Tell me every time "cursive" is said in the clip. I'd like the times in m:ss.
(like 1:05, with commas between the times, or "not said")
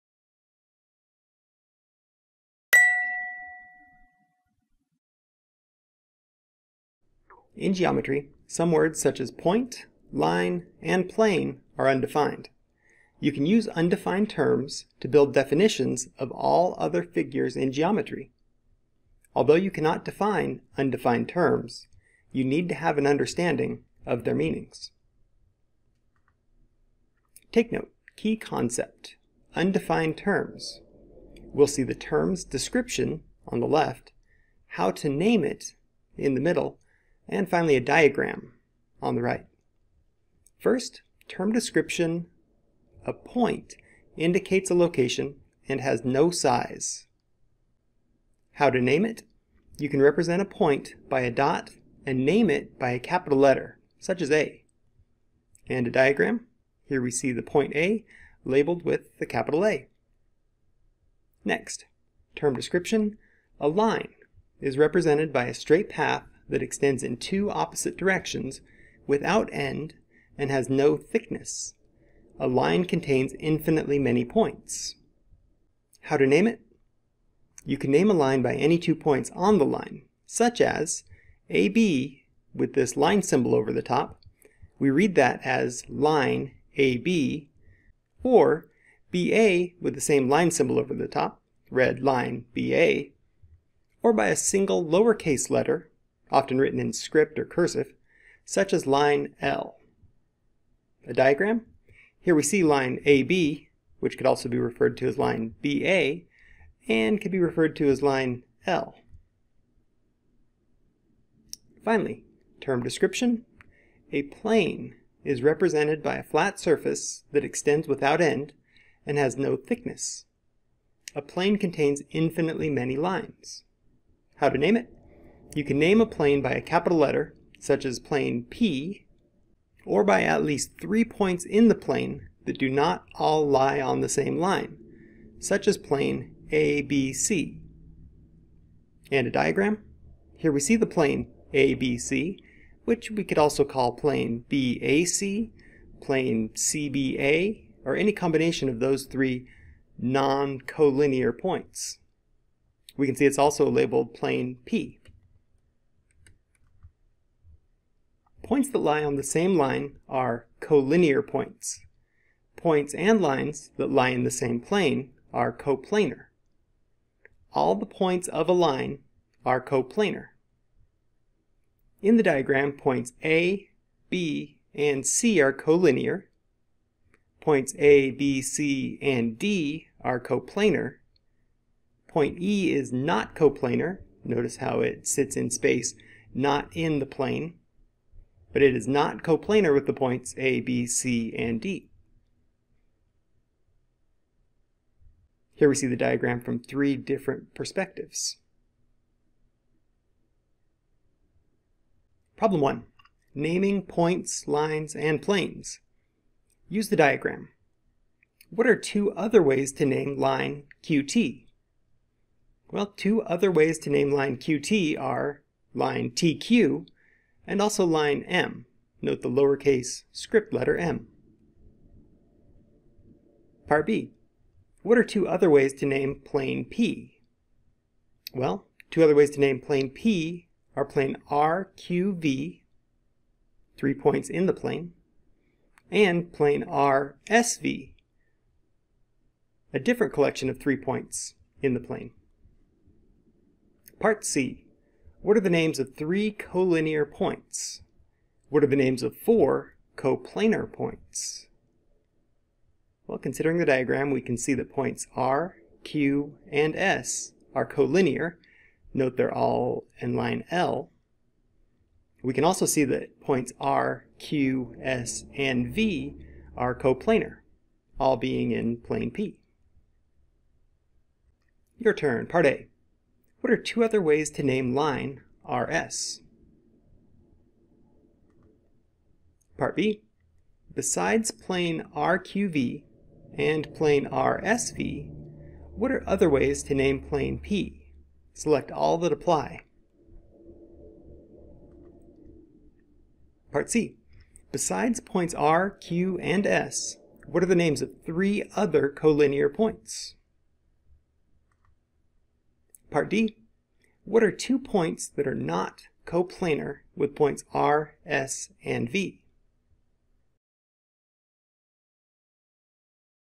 1:37.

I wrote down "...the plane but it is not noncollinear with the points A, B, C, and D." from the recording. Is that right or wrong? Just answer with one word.
wrong.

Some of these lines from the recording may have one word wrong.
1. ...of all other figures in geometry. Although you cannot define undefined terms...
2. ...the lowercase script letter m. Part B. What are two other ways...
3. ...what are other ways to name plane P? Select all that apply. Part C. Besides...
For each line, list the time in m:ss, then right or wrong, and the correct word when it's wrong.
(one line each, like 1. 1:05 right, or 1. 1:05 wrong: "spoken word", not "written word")
1. 0:16 right
2. 3:39 right
3. 4:45 right.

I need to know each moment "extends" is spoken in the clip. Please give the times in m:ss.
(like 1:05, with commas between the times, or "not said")
1:06, 1:57.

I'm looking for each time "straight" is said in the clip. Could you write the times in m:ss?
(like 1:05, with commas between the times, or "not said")
1:05.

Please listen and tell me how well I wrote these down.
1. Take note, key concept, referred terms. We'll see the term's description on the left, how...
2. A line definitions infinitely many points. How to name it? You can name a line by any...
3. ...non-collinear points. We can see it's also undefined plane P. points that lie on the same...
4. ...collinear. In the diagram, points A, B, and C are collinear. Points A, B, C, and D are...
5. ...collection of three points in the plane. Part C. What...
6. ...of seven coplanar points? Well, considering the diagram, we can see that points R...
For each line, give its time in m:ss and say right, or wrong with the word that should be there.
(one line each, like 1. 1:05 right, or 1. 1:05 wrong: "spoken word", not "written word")
1. 0:27 wrong: "undefined", not "referred"
2. 1:12 wrong: "contains", not "definitions"
3. 2:29 wrong: "labeled", not "undefined"
4. 2:49 wrong: "coplanar", not "collinear"
5. 4:00 right
6. 4:09 wrong: "four", not "seven".